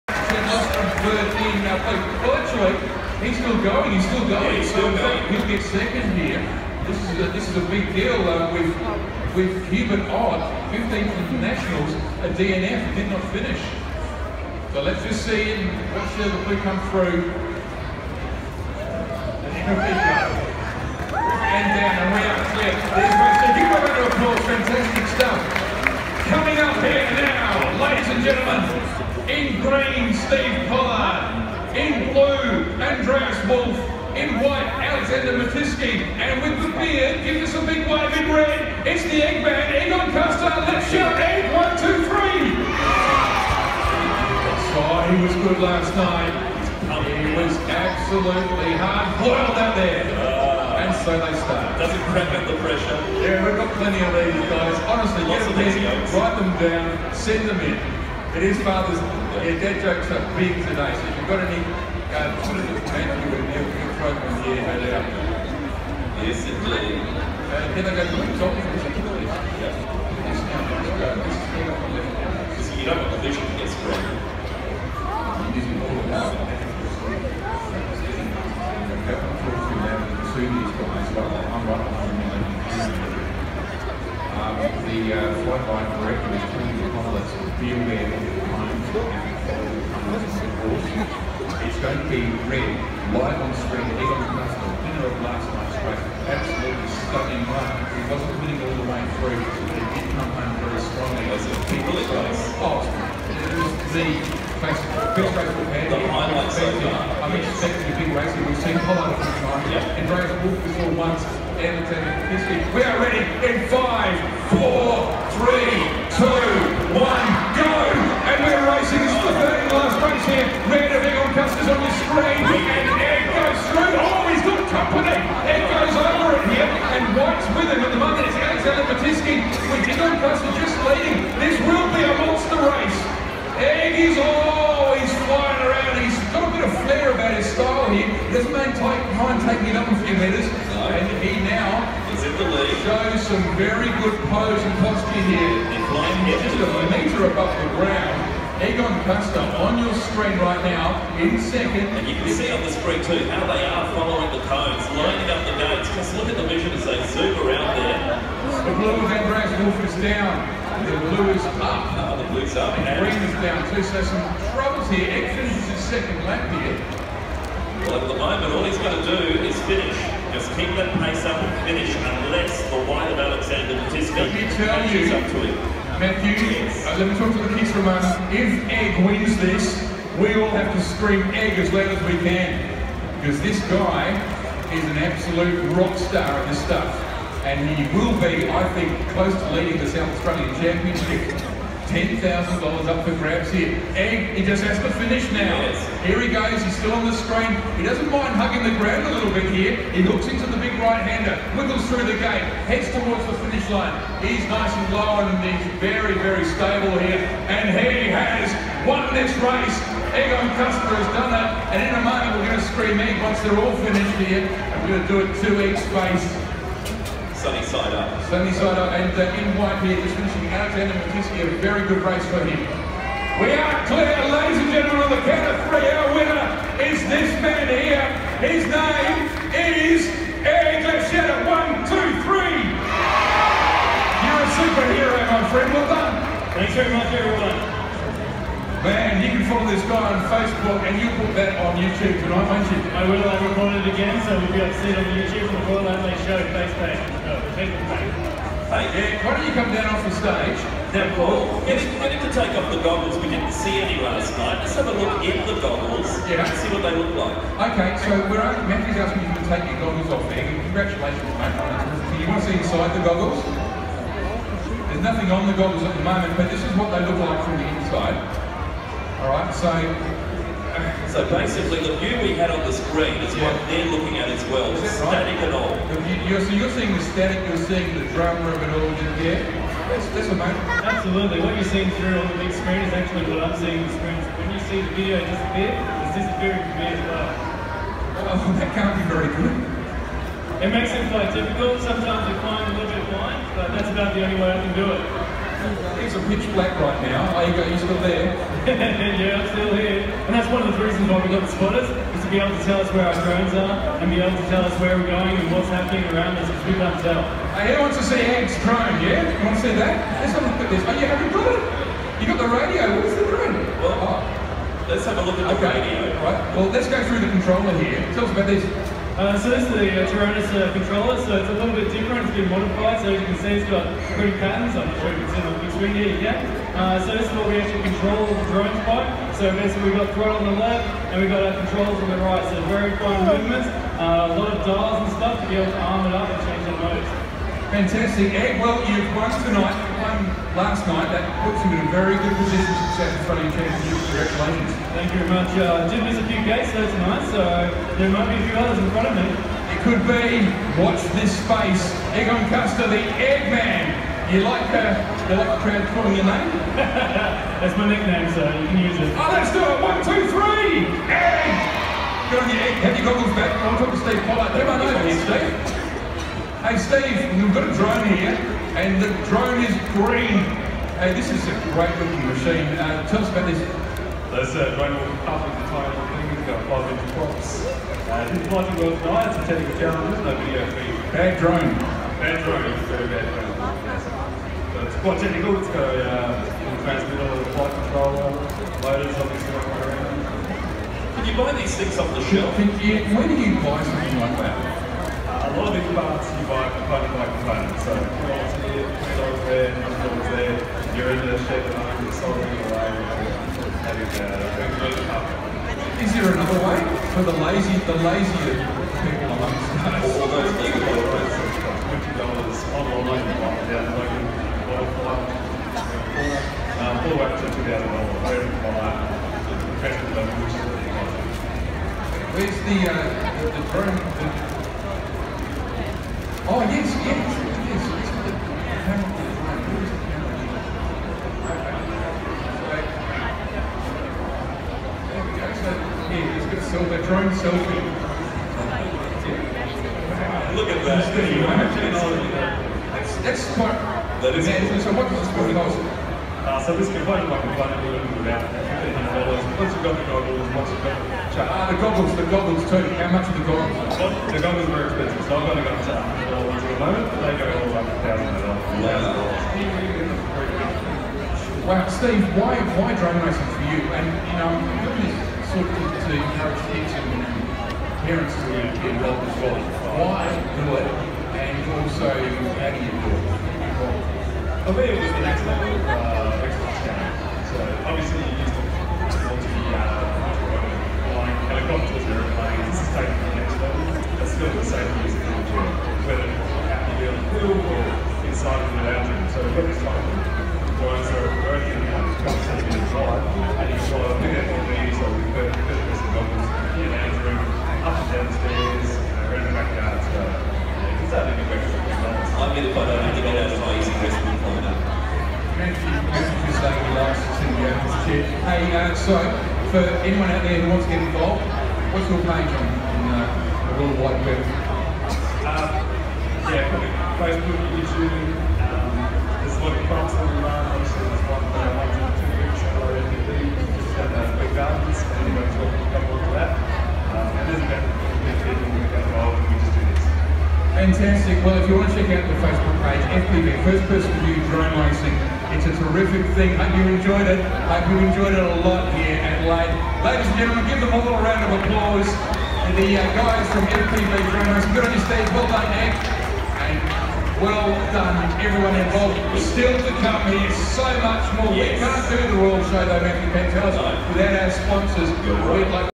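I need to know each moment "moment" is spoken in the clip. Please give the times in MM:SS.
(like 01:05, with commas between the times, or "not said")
02:48, 03:32, 04:26, 07:36.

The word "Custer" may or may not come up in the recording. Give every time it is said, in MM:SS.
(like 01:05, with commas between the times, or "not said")
00:40, 02:29, 03:30, 05:52.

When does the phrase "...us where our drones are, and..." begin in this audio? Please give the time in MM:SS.
05:02.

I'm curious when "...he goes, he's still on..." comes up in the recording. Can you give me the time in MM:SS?
03:16.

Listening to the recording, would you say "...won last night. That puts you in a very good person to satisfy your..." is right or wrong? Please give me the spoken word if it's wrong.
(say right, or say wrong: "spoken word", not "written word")
wrong: "position", not "person".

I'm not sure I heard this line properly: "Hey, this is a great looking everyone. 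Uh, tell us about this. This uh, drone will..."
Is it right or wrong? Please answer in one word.
wrong.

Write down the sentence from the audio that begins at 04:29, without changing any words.
All right, so so basically the view we had on the screen is yeah.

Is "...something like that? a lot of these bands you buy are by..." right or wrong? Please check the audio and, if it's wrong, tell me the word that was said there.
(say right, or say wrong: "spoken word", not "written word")
right.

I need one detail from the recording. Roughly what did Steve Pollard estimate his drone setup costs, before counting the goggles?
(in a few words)
$1,500.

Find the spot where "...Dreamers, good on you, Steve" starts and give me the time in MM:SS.
09:04.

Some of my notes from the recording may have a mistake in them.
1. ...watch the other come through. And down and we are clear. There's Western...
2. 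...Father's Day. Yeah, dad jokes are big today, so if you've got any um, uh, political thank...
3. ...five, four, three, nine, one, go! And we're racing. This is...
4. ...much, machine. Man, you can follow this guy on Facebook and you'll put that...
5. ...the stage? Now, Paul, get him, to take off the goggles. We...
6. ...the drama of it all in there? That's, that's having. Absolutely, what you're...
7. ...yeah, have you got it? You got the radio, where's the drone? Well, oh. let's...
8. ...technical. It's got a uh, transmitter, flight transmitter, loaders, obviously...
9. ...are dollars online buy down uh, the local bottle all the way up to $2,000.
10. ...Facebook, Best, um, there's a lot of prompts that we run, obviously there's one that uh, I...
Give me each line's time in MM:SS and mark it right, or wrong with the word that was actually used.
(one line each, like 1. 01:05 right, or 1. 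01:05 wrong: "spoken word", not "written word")
1. 00:15 right
2. 00:58 right
3. 01:53 wrong: "two", not "nine"
4. 03:56 wrong: "everyone", not "machine"
5. 04:10 right
6. 04:37 wrong: "amazing", not "having"
7. 05:10 right
8. 06:25 wrong: "controller", not "transmitter"
9. 06:50 right
10. 08:37 wrong: "YouTube", not "Best".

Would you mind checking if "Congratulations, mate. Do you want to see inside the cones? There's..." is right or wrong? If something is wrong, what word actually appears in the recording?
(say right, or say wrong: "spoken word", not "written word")
wrong: "goggles", not "cones".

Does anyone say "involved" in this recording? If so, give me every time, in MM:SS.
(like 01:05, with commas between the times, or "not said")
07:48, 08:30, 08:49, 09:08.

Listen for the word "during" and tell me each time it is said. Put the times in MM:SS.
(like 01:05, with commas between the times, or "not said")
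not said.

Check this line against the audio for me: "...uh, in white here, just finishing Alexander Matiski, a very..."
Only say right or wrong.
right.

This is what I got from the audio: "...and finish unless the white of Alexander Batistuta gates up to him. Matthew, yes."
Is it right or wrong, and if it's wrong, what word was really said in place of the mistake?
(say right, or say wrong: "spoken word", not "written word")
wrong: "catches", not "gates".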